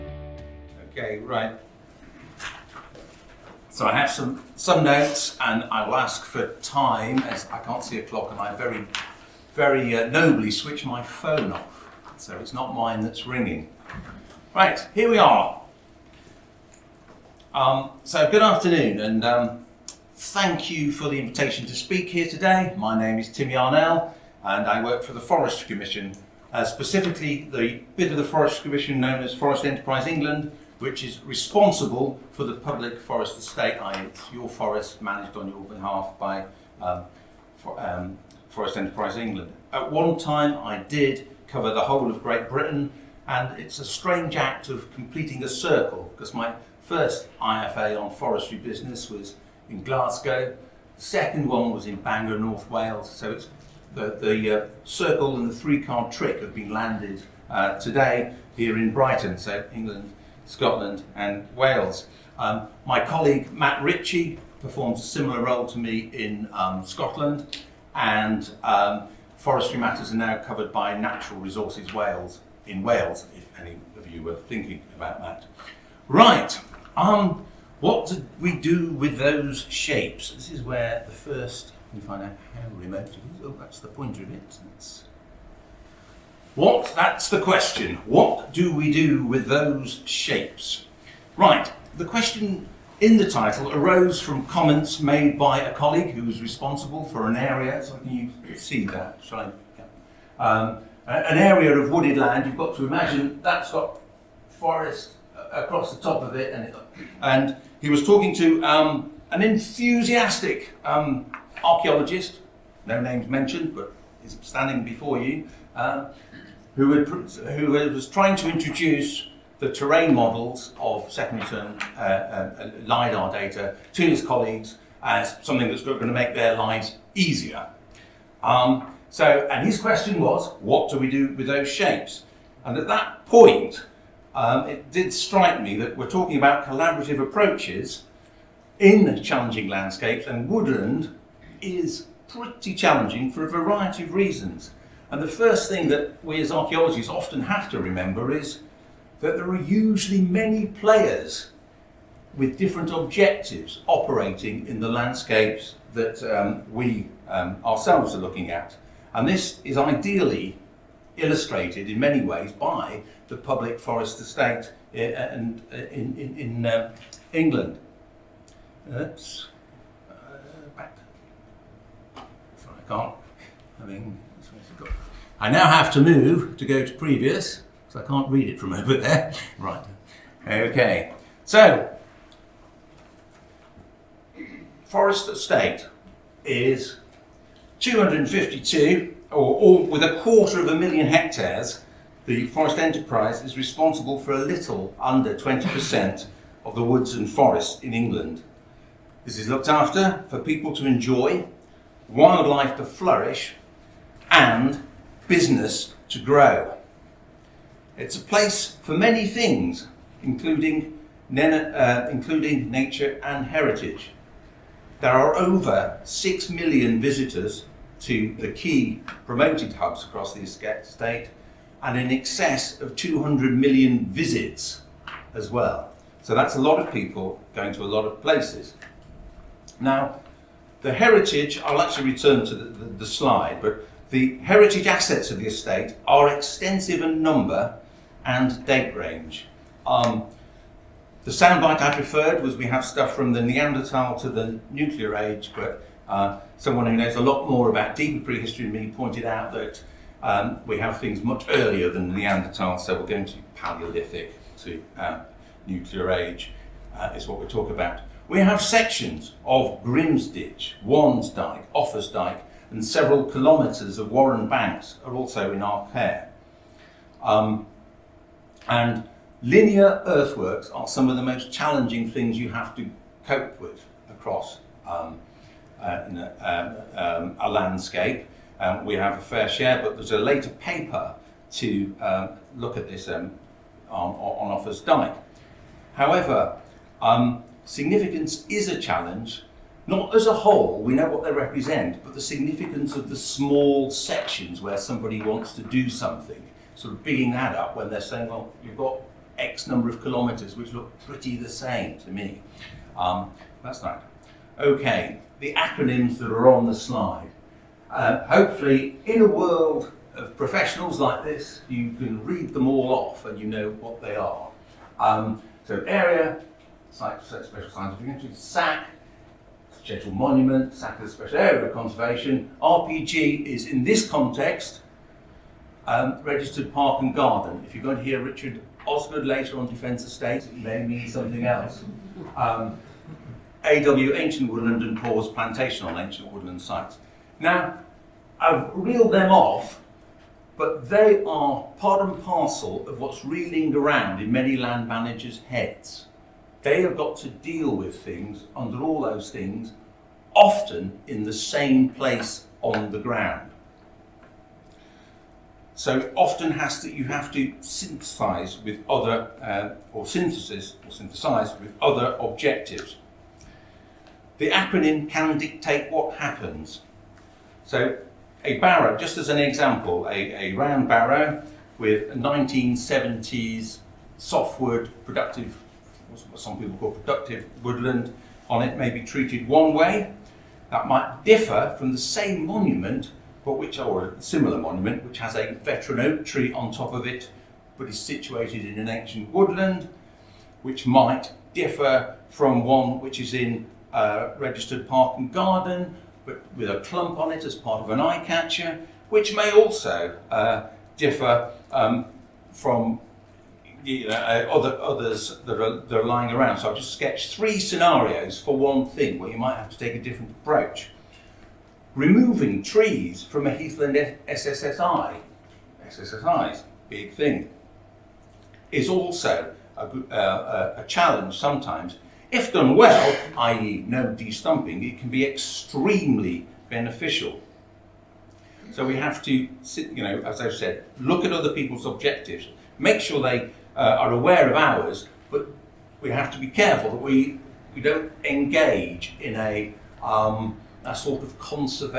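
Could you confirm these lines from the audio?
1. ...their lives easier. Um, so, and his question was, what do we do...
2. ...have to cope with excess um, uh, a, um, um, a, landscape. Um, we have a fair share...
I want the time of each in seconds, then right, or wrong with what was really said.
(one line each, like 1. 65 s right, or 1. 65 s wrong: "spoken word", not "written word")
1. 126 s right
2. 272 s wrong: "across", not "excess".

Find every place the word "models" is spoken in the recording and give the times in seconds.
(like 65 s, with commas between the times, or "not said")
120 s.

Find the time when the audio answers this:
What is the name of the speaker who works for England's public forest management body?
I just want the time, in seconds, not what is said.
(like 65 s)
23 s.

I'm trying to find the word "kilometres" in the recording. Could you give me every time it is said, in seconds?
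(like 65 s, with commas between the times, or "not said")
263 s, 300 s.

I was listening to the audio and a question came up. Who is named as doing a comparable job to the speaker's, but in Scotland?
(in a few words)
Matt Ritchie.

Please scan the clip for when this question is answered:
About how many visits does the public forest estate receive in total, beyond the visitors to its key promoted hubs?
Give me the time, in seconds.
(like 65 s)
221 s.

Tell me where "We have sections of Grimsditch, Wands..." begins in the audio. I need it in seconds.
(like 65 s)
258 s.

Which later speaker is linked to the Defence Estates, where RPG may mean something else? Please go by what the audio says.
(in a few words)
Richard Osgood.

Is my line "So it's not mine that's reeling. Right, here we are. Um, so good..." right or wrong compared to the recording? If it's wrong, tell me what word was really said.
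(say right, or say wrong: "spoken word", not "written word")
wrong: "ringing", not "reeling".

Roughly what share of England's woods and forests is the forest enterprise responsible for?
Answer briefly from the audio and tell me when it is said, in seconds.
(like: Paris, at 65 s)
a little under 20%, at 194 s.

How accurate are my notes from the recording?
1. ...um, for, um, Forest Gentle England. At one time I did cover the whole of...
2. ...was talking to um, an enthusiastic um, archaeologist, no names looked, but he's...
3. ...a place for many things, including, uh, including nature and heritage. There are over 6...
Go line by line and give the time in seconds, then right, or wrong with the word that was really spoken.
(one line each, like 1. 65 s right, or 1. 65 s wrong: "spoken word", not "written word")
1. 36 s wrong: "Enterprise", not "Gentle"
2. 107 s wrong: "mentioned", not "looked"
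3. 208 s right.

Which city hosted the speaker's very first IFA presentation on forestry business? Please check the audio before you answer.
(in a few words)
Glasgow.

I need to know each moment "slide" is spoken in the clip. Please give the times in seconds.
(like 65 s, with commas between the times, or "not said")
233 s, 306 s.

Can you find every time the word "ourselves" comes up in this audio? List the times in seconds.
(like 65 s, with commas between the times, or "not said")
157 s.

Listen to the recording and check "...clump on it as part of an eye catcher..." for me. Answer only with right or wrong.
right.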